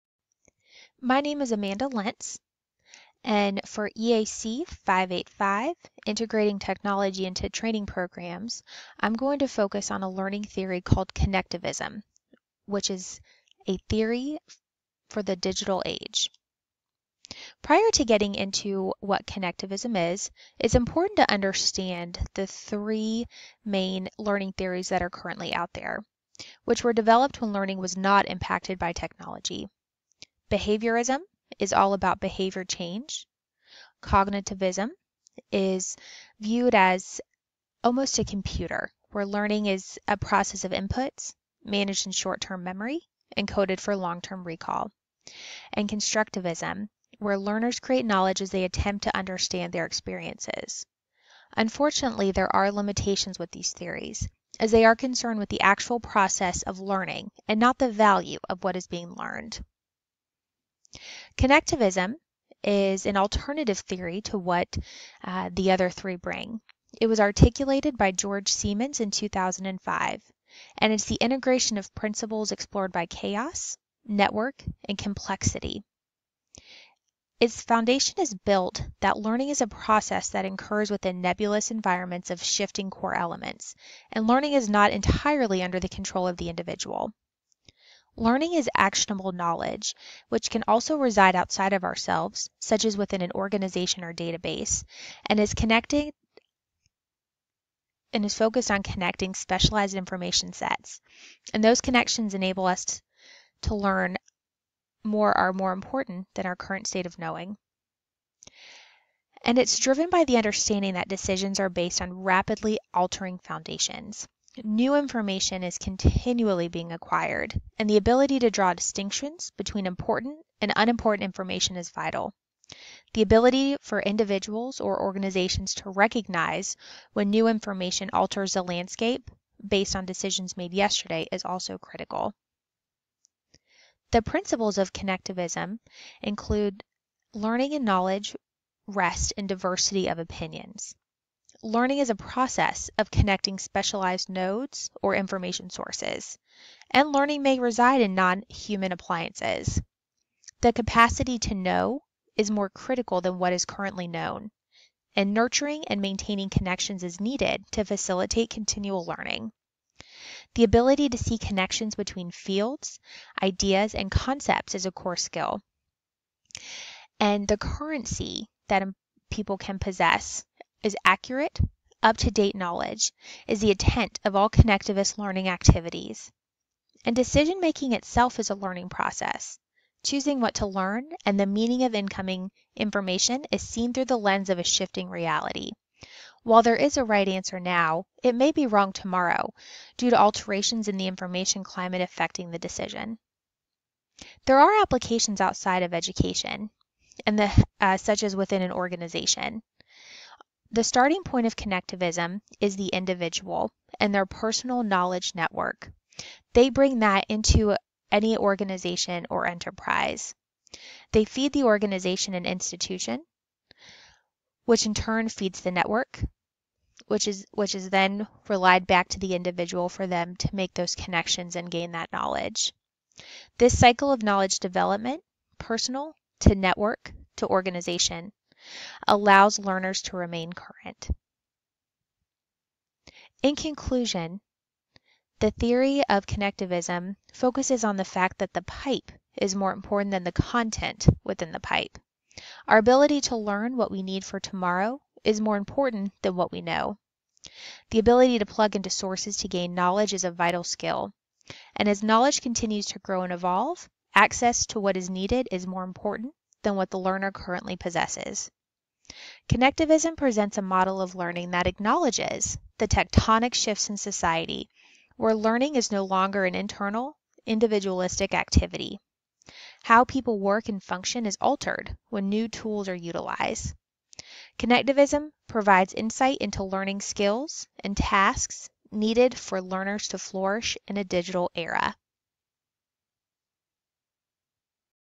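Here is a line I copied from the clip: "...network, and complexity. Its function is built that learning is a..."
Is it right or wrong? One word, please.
wrong.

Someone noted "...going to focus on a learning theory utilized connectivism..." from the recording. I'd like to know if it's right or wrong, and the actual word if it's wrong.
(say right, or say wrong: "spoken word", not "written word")
wrong: "called", not "utilized".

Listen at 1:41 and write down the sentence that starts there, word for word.
And those connections enable us to learn more are more important than our current state of knowing.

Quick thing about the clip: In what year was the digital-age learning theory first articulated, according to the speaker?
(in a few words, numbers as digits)
2005.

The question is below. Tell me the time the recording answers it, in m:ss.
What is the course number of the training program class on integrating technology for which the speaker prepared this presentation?
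0:03.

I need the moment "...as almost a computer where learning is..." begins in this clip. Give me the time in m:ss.
0:36.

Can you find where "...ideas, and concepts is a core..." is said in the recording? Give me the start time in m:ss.
2:43.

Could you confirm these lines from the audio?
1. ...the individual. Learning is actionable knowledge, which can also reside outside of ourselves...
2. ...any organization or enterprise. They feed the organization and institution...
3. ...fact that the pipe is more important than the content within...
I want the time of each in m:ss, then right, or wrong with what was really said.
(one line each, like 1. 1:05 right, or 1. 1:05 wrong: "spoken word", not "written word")
1. 1:26 right
2. 3:28 right
3. 3:58 right.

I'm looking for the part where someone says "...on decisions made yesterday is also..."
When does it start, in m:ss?
2:09.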